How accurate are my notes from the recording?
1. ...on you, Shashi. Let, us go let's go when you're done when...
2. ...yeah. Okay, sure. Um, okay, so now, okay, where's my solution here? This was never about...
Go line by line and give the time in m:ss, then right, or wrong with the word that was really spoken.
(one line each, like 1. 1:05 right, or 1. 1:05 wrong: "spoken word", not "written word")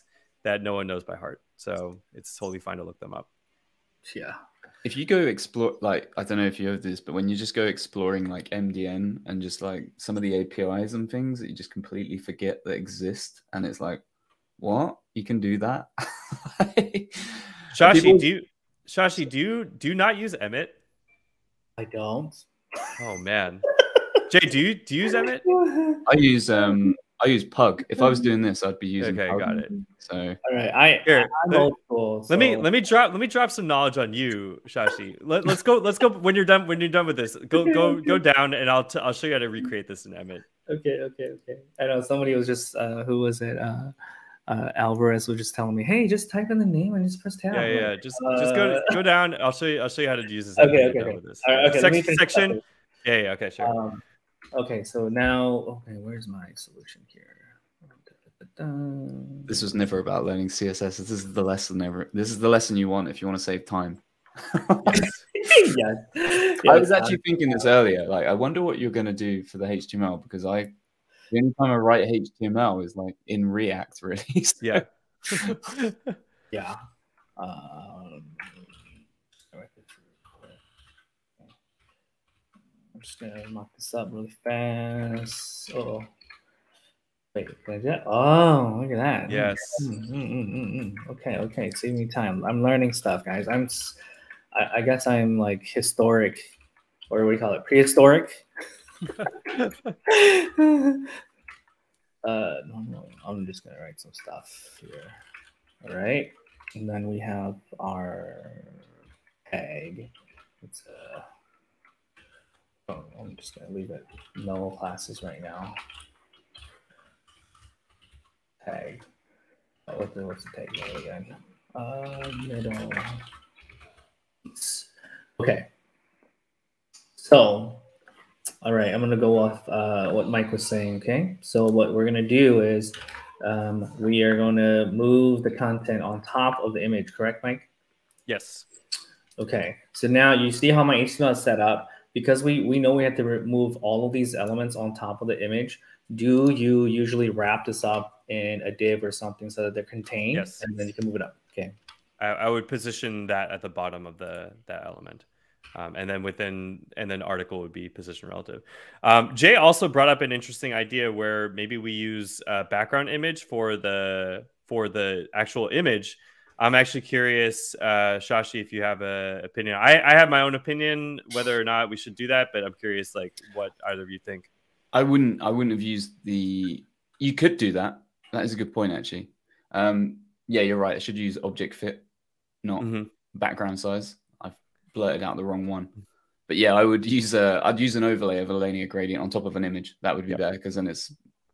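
1. 0:33 right
2. 0:53 right.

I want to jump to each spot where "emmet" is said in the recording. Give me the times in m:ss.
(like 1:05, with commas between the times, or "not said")
0:20, 0:25, 0:40.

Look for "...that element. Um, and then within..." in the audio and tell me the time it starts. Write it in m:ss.
2:34.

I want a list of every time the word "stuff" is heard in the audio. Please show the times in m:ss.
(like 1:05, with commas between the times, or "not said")
1:32, 1:44.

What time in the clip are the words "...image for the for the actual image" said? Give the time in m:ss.
2:43.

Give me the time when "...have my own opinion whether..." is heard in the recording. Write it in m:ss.
2:50.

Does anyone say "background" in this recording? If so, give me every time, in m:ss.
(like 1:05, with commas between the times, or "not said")
2:42, 3:03.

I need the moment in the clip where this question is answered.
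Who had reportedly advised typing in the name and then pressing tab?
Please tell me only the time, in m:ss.
0:44.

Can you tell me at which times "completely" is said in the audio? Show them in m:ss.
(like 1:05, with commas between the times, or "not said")
0:11.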